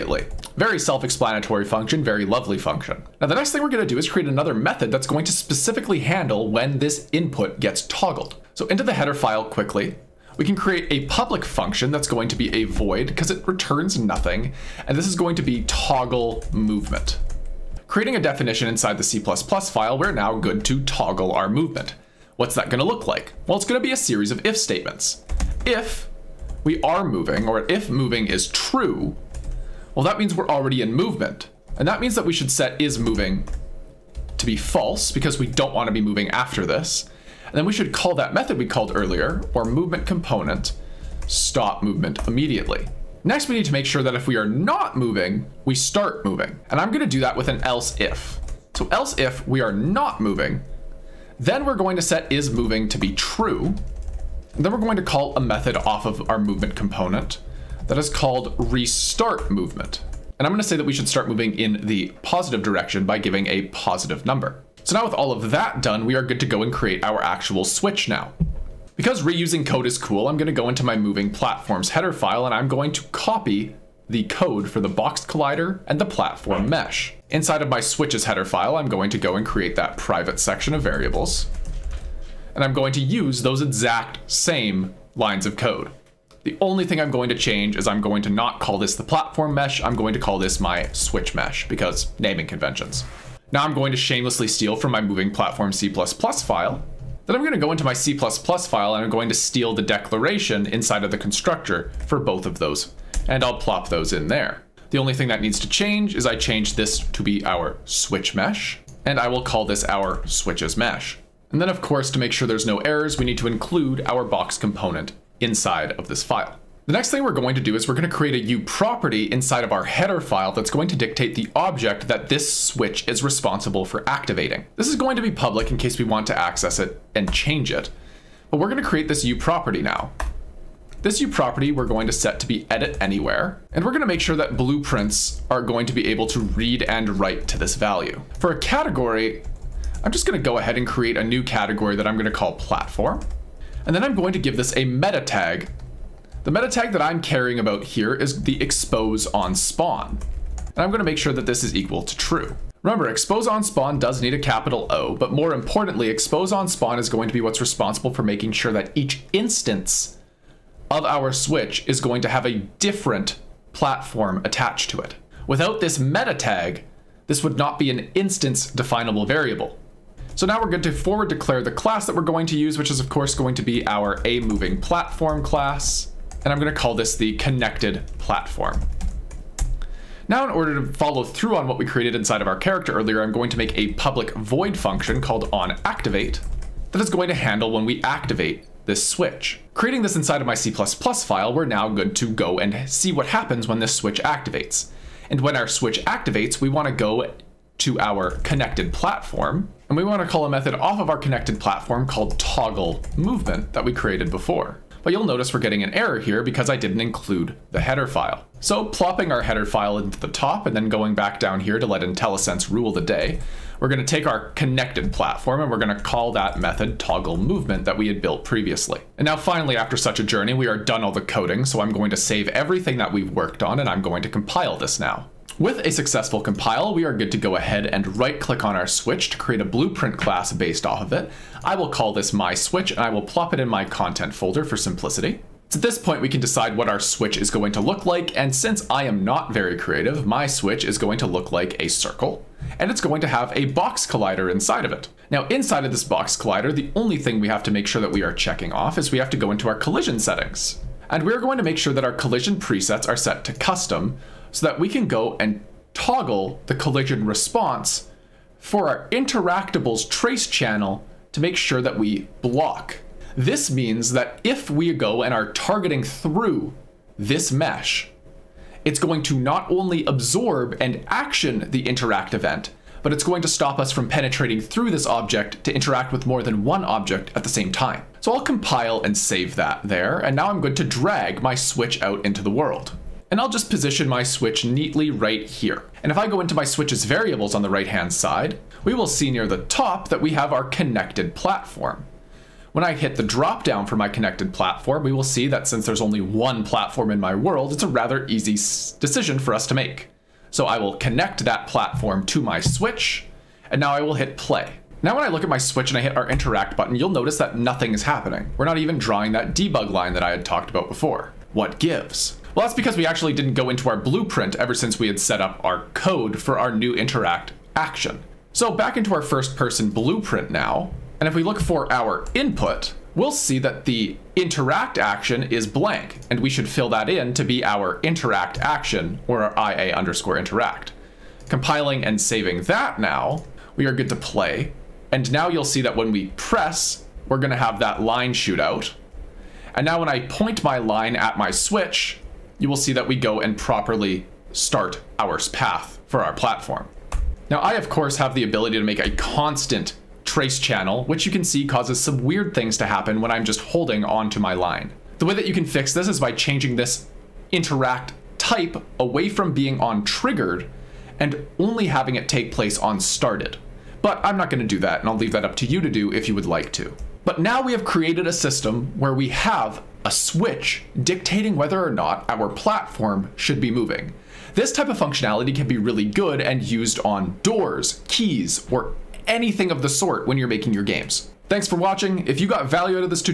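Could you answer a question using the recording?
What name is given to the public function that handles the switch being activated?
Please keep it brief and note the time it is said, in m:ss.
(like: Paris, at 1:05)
onActivate, at 3:05.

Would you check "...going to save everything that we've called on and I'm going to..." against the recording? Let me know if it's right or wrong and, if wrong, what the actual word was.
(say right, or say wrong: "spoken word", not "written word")
wrong: "worked", not "called".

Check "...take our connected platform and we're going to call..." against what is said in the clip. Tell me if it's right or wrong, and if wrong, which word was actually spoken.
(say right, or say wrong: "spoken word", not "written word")
right.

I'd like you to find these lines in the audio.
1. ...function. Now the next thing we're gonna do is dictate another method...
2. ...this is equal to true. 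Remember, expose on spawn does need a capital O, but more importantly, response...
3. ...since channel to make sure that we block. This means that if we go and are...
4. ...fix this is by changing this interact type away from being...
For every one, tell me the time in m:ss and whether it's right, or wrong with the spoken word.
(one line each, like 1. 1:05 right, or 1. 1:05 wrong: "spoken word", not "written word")
1. 0:02 wrong: "create", not "dictate"
2. 2:31 wrong: "expose", not "response"
3. 4:20 wrong: "trace", not "since"
4. 5:55 right.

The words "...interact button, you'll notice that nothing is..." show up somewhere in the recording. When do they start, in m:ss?
5:06.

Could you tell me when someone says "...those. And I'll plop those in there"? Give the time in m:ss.
1:42.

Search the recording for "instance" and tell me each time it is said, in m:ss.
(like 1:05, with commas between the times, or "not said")
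2:39, 2:48.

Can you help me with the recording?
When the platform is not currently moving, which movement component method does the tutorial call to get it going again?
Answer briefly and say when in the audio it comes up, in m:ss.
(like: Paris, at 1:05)
restart movement, at 0:58.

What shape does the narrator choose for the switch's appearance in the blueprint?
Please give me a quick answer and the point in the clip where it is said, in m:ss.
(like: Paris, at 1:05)
a circle, at 4:01.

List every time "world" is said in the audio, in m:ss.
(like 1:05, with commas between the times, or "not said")
4:42, 4:57.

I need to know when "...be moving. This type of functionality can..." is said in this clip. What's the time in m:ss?
6:13.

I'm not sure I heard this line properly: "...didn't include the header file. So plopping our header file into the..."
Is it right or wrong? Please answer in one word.
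right.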